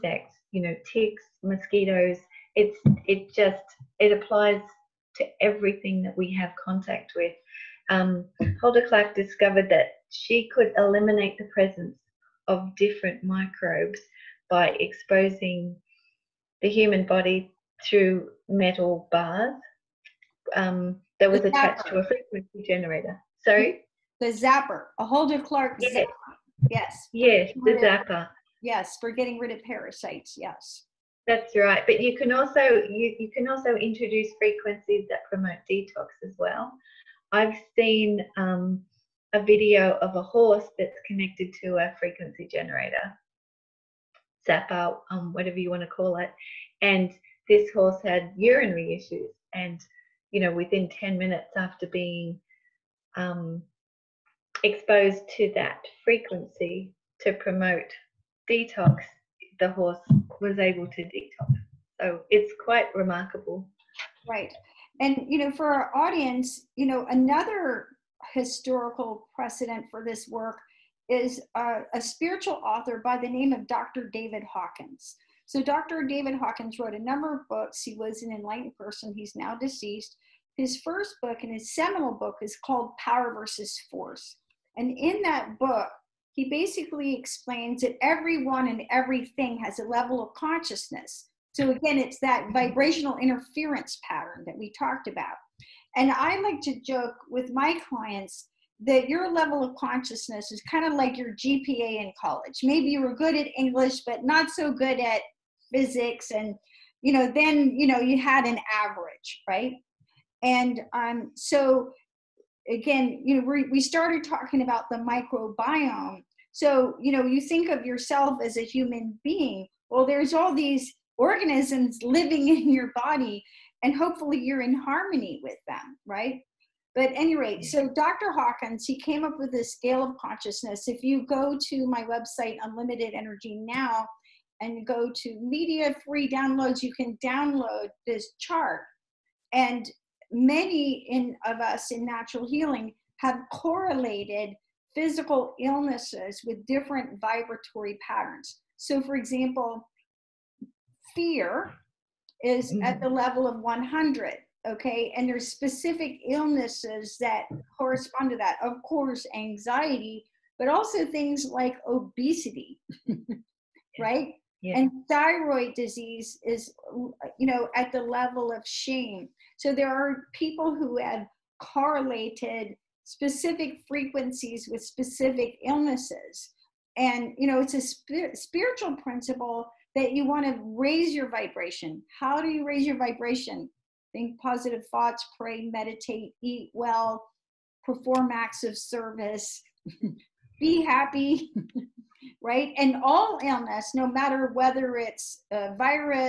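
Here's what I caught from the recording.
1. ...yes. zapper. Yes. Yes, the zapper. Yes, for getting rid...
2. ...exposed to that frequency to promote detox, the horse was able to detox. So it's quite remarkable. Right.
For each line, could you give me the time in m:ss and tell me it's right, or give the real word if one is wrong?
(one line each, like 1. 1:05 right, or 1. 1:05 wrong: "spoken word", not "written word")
1. 0:25 right
2. 0:54 right.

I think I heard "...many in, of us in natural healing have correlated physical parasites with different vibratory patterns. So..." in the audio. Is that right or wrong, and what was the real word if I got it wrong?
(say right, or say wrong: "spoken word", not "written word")
wrong: "illnesses", not "parasites".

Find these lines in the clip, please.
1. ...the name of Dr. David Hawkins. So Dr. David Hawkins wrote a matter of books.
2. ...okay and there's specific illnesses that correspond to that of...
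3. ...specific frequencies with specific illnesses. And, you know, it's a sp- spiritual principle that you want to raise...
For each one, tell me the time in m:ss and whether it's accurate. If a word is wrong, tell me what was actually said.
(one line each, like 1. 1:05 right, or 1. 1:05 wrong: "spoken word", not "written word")
1. 1:13 wrong: "number", not "matter"
2. 2:34 right
3. 2:53 right.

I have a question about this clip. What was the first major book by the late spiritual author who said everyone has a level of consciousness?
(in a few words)
Power versus Force.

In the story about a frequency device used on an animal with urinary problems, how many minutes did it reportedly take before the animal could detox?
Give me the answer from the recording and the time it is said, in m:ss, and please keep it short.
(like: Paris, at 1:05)
10, at 0:50.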